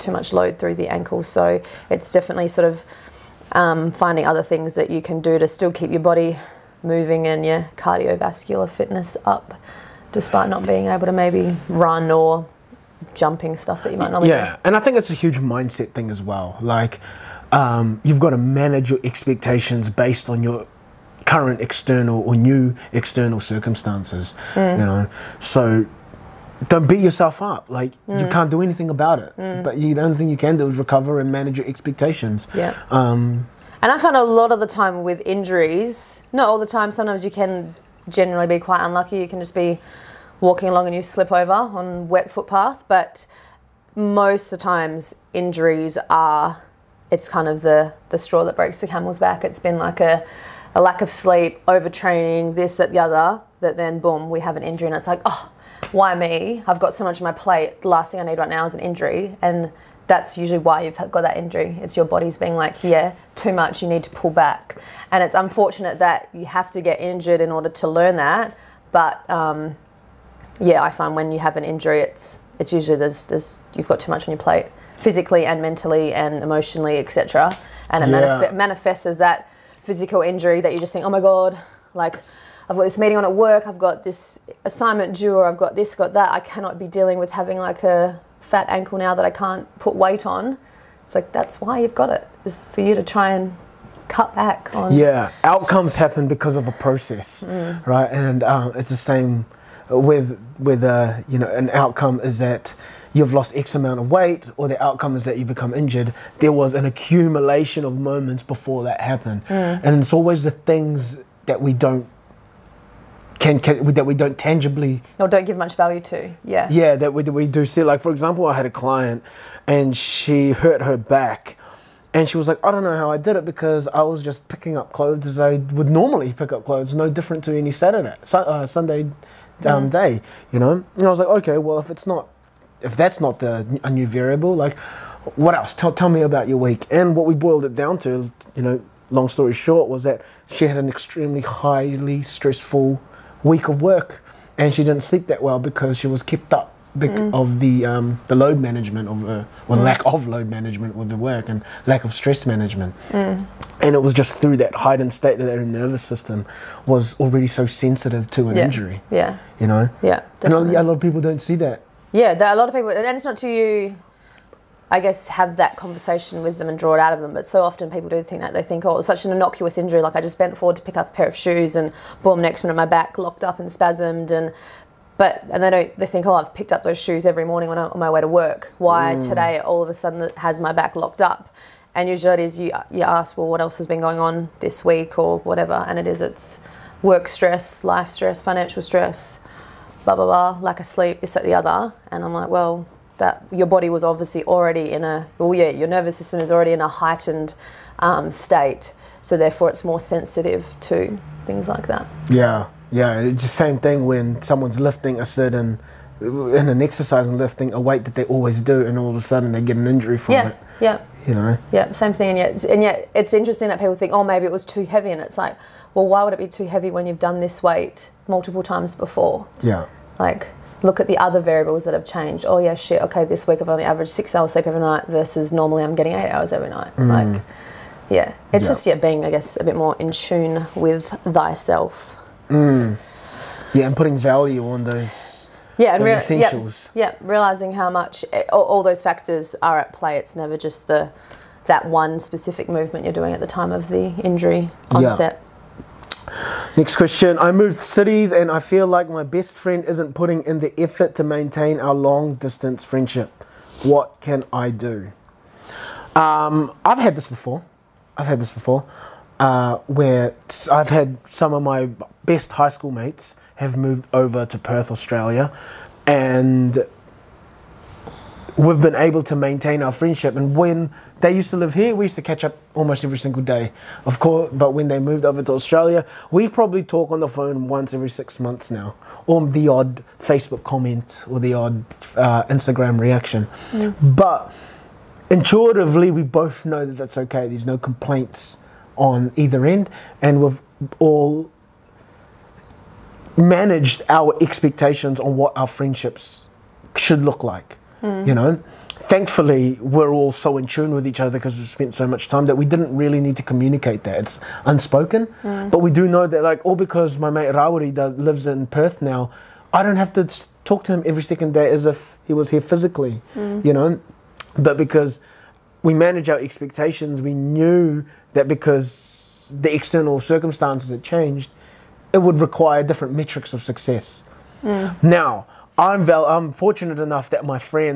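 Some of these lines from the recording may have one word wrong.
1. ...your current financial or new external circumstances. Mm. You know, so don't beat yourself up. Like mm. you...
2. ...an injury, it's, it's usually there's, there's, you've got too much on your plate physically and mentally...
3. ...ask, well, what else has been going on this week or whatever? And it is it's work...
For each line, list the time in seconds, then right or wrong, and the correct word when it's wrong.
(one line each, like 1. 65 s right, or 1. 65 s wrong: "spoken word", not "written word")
1. 20 s wrong: "external", not "financial"
2. 71 s right
3. 183 s right.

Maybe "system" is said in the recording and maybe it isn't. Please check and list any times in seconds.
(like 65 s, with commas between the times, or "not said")
156 s, 196 s.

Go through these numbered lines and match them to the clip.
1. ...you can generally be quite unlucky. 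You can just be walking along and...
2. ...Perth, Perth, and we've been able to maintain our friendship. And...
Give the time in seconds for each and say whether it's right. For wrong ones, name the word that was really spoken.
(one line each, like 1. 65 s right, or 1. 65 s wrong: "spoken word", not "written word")
1. 37 s right
2. 264 s wrong: "Australia", not "Perth".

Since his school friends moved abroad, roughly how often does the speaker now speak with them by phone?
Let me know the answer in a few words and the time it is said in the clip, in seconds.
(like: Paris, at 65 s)
once every 6 months, at 277 s.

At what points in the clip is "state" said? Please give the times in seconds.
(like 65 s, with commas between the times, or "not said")
155 s, 198 s.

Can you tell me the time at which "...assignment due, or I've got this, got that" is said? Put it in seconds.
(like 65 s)
84 s.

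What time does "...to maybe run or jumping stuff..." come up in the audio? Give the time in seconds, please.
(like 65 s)
11 s.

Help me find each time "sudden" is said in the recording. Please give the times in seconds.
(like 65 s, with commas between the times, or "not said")
179 s, 209 s.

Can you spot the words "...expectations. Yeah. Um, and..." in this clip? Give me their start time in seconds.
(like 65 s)
31 s.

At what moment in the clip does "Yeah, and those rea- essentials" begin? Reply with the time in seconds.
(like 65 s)
235 s.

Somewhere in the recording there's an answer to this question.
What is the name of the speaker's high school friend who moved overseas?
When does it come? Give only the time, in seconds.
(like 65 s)
307 s.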